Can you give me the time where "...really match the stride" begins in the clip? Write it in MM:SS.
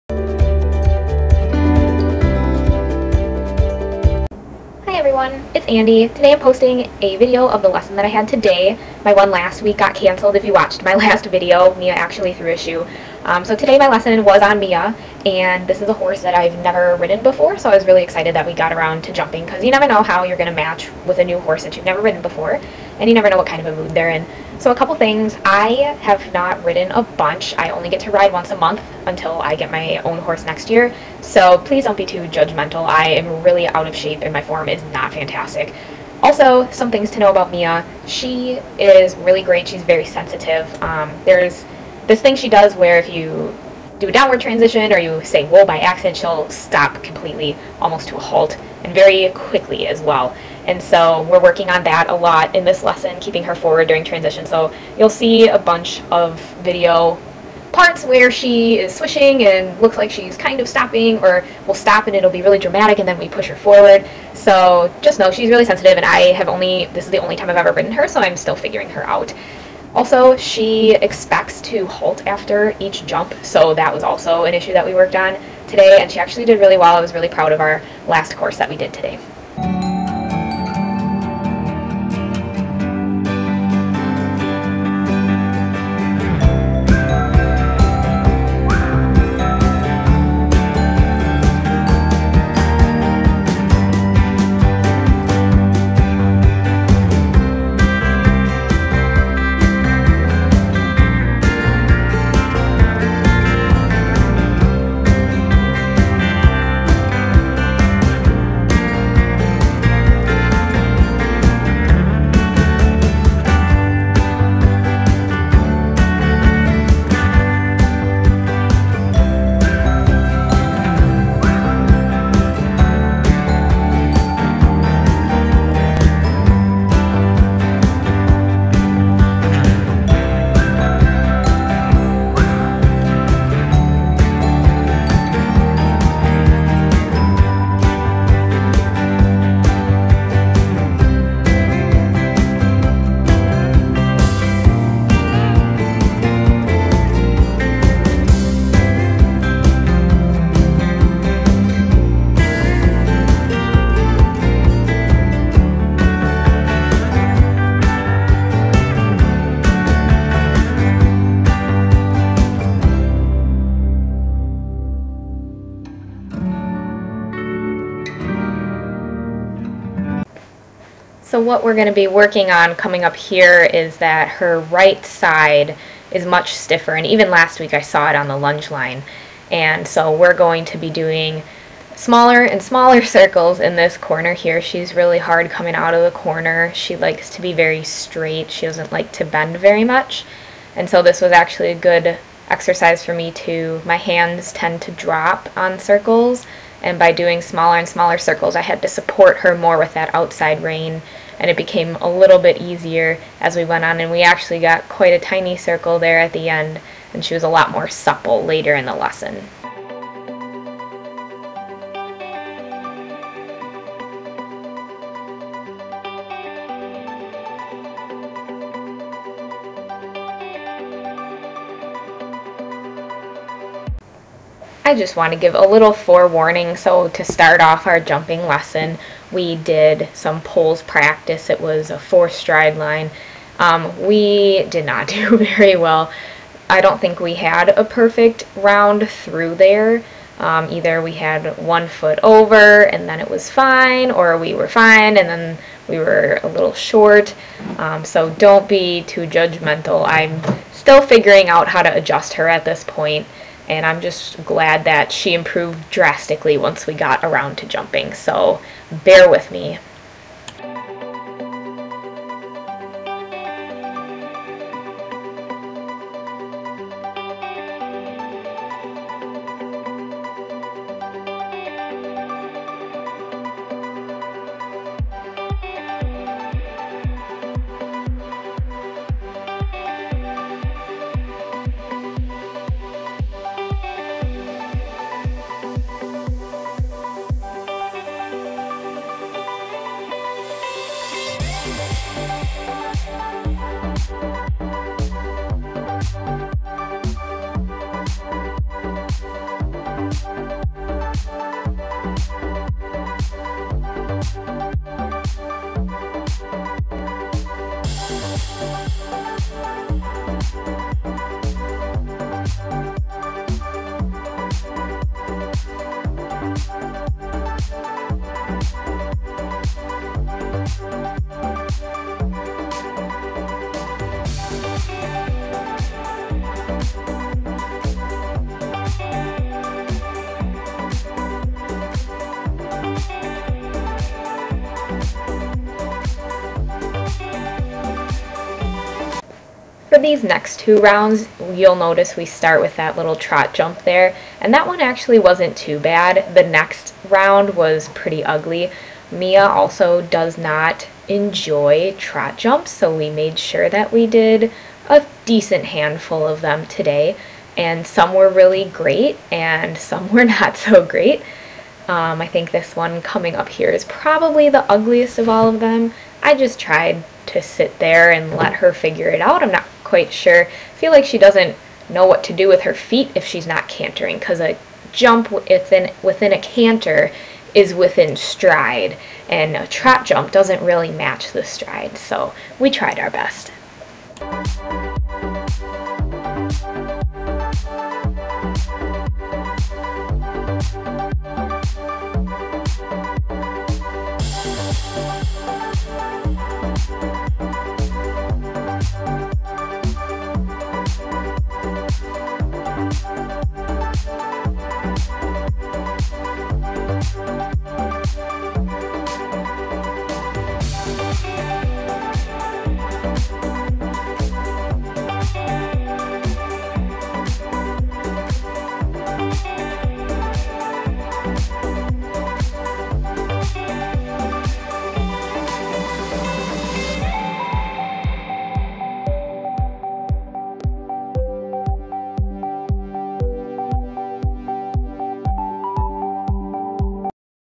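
06:20.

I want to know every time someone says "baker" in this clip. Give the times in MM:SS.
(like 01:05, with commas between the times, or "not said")
not said.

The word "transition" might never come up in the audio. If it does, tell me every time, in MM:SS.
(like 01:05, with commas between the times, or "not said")
00:44, 00:54.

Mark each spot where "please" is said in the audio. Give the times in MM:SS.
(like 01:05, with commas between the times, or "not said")
00:31.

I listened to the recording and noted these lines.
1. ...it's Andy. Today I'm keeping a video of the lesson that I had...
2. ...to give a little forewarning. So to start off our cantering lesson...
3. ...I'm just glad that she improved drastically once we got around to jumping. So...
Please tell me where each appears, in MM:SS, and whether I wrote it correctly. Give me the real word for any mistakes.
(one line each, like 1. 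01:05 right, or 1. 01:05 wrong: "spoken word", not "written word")
1. 00:05 wrong: "posting", not "keeping"
2. 03:45 wrong: "jumping", not "cantering"
3. 04:13 right.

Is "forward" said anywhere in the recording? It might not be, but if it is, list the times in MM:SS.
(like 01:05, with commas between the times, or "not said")
00:53, 01:03.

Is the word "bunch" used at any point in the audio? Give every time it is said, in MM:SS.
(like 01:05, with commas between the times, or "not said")
00:27, 00:55.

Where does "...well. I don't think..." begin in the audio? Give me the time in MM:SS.
03:55.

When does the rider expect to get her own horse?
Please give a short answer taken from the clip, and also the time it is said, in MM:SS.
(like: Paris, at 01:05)
next year, at 00:30.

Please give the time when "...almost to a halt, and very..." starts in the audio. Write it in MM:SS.
00:47.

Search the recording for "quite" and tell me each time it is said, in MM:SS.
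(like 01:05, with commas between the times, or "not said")
03:24, 06:09.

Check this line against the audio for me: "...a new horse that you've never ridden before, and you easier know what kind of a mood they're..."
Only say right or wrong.
wrong.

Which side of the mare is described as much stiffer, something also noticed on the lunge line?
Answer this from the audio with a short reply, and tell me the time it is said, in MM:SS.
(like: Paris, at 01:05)
right side, at 02:54.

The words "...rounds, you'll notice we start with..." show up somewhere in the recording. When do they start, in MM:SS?
05:40.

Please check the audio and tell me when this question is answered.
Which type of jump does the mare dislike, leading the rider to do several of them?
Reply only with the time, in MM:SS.
05:51.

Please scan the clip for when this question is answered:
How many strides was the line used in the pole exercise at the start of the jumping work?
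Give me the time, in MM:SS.
03:51.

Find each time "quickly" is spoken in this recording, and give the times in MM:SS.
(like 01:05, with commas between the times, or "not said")
00:49.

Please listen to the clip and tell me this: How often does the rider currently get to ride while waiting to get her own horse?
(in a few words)
once a month.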